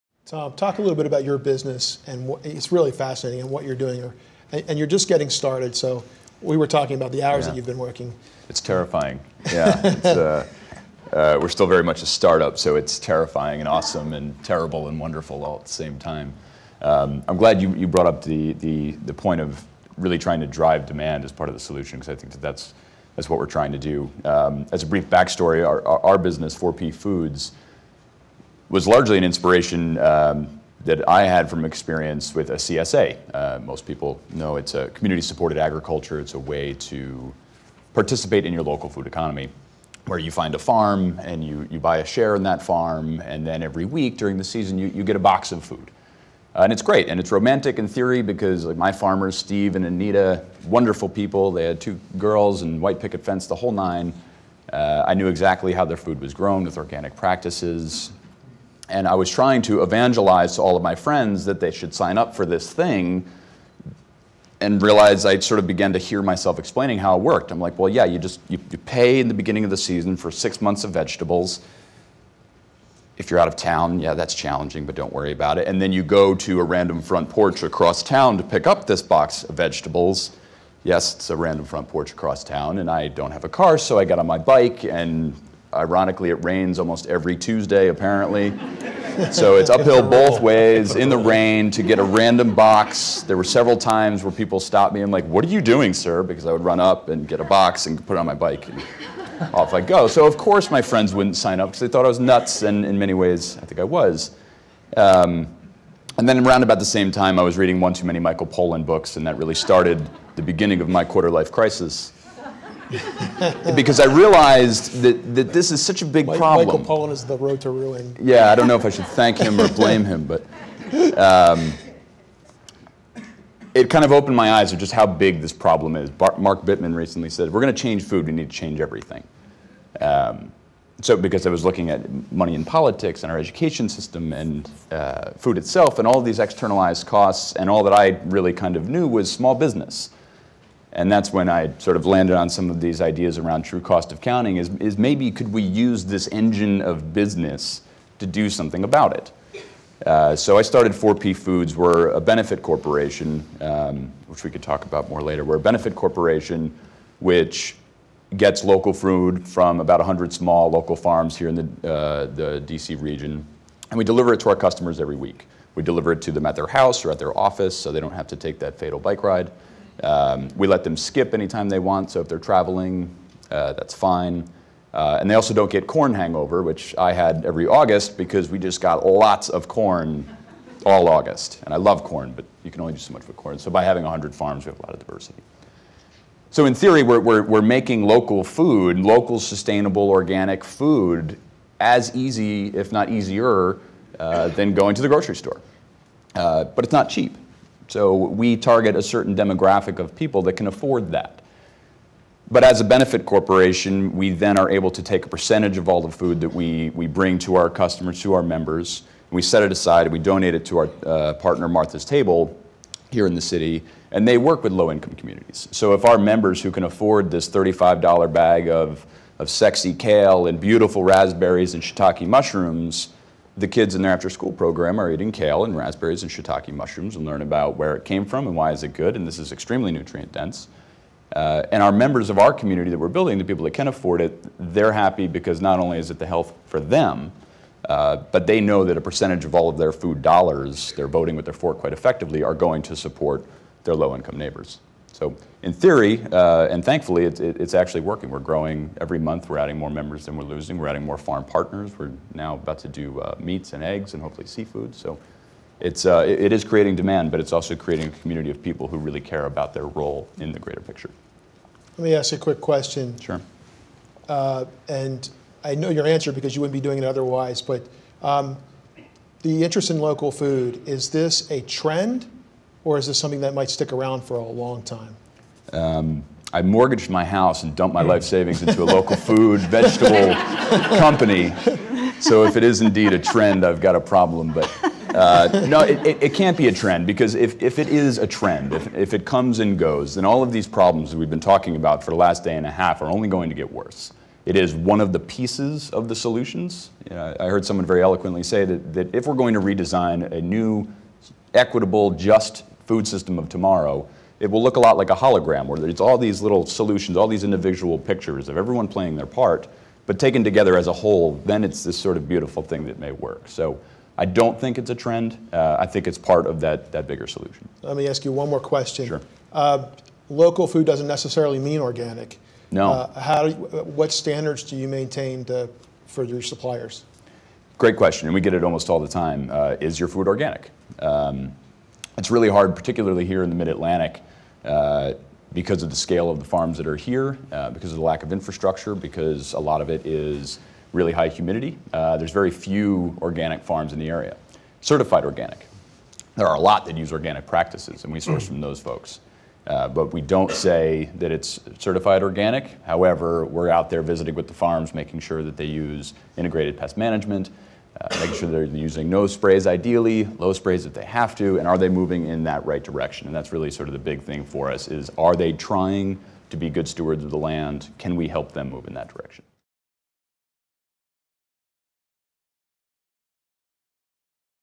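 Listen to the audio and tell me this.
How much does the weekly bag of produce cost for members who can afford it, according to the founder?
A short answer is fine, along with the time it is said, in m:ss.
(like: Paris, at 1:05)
$35, at 3:37.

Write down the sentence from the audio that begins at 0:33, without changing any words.
Uh, most people know it's a community supported agriculture, it's a way to participate in your local food economy.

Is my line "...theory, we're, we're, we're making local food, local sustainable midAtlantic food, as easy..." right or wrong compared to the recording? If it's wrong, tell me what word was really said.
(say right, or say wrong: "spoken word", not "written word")
wrong: "organic", not "midAtlantic".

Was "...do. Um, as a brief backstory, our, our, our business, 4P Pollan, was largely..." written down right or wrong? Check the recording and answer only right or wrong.
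wrong.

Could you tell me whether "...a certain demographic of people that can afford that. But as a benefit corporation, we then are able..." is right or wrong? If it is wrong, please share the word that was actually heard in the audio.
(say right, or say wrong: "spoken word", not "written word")
right.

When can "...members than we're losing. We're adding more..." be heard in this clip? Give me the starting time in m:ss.
4:09.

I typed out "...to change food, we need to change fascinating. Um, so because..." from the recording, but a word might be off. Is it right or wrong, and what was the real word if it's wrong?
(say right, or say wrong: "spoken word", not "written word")
wrong: "everything", not "fascinating".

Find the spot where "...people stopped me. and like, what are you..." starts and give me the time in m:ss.
1:34.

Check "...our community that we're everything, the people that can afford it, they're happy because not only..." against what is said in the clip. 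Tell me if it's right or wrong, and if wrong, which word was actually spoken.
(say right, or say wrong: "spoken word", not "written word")
wrong: "building", not "everything".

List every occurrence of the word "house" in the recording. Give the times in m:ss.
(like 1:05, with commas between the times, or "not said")
2:46, 4:37.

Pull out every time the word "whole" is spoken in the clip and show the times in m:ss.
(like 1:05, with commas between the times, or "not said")
0:53, 5:10.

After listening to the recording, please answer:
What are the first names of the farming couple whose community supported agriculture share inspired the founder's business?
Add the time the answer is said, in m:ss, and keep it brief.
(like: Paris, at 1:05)
Steve and Anita, at 0:49.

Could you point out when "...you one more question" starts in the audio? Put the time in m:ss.
5:18.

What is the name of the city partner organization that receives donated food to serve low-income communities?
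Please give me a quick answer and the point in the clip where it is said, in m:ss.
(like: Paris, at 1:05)
Martha's Table, at 3:31.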